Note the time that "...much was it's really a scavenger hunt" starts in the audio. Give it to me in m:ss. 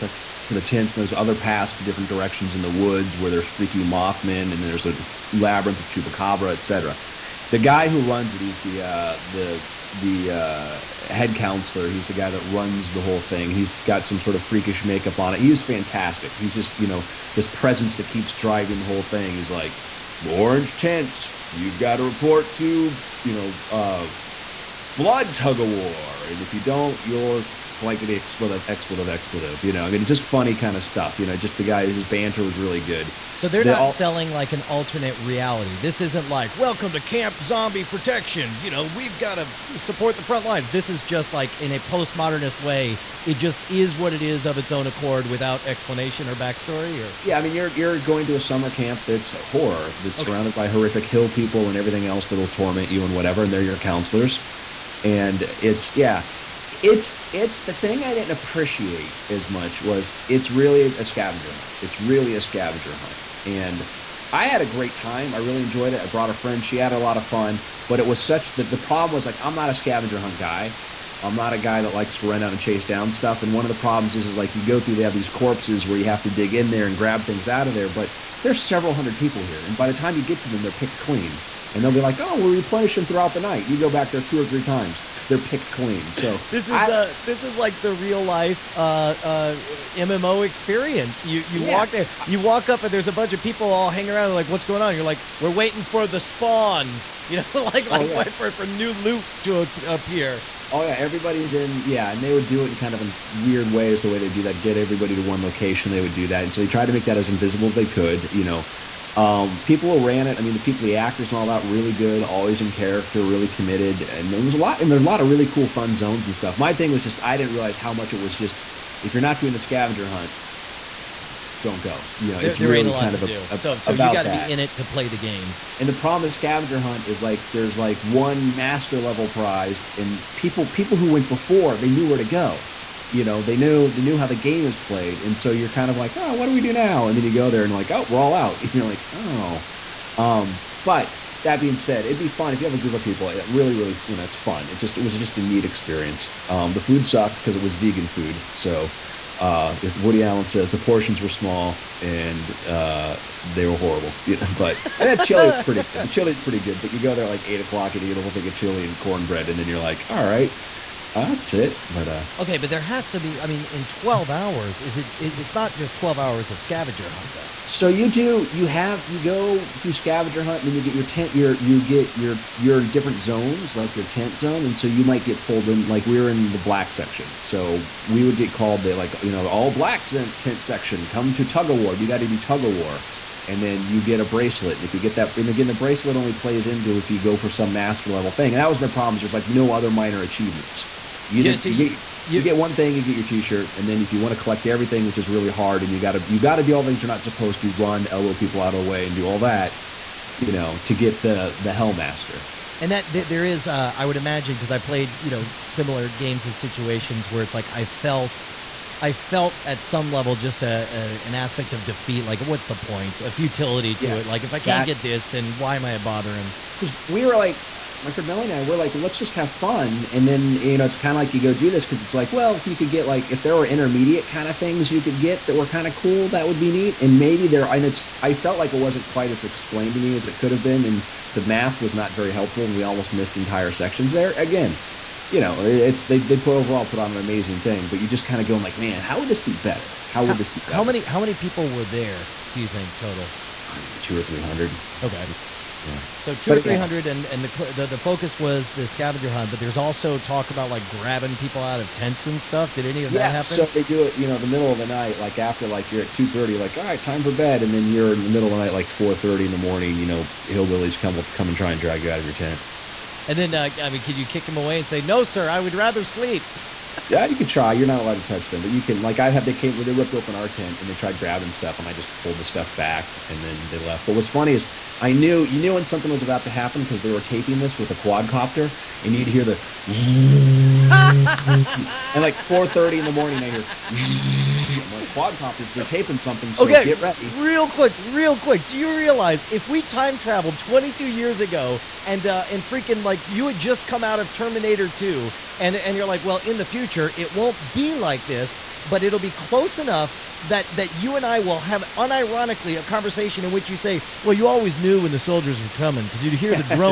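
0:59.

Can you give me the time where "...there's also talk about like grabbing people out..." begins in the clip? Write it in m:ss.
4:09.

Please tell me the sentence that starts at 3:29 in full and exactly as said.
I felt at some level just a, a, an aspect of defeat.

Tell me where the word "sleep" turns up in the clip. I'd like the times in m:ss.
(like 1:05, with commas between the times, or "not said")
4:26.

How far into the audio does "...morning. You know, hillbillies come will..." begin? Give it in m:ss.
4:19.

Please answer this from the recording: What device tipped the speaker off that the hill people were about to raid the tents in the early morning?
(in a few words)
quadcopter.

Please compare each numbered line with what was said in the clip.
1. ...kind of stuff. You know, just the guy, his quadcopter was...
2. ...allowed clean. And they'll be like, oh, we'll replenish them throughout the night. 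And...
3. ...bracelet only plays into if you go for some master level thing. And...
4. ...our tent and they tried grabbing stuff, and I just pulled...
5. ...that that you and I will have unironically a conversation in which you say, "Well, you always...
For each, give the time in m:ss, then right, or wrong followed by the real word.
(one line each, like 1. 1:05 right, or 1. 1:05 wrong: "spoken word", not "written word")
1. 0:30 wrong: "banter", not "quadcopter"
2. 1:20 wrong: "picked", not "allowed"
3. 3:05 right
4. 4:30 right
5. 5:00 right.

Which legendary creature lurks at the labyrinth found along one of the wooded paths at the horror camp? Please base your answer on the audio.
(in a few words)
chupacabra.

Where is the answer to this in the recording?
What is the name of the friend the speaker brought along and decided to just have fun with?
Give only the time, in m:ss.
3:38.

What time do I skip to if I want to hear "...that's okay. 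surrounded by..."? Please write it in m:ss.
0:50.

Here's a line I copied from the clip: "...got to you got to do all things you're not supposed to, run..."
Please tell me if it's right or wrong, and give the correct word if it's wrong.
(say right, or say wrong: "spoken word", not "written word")
right.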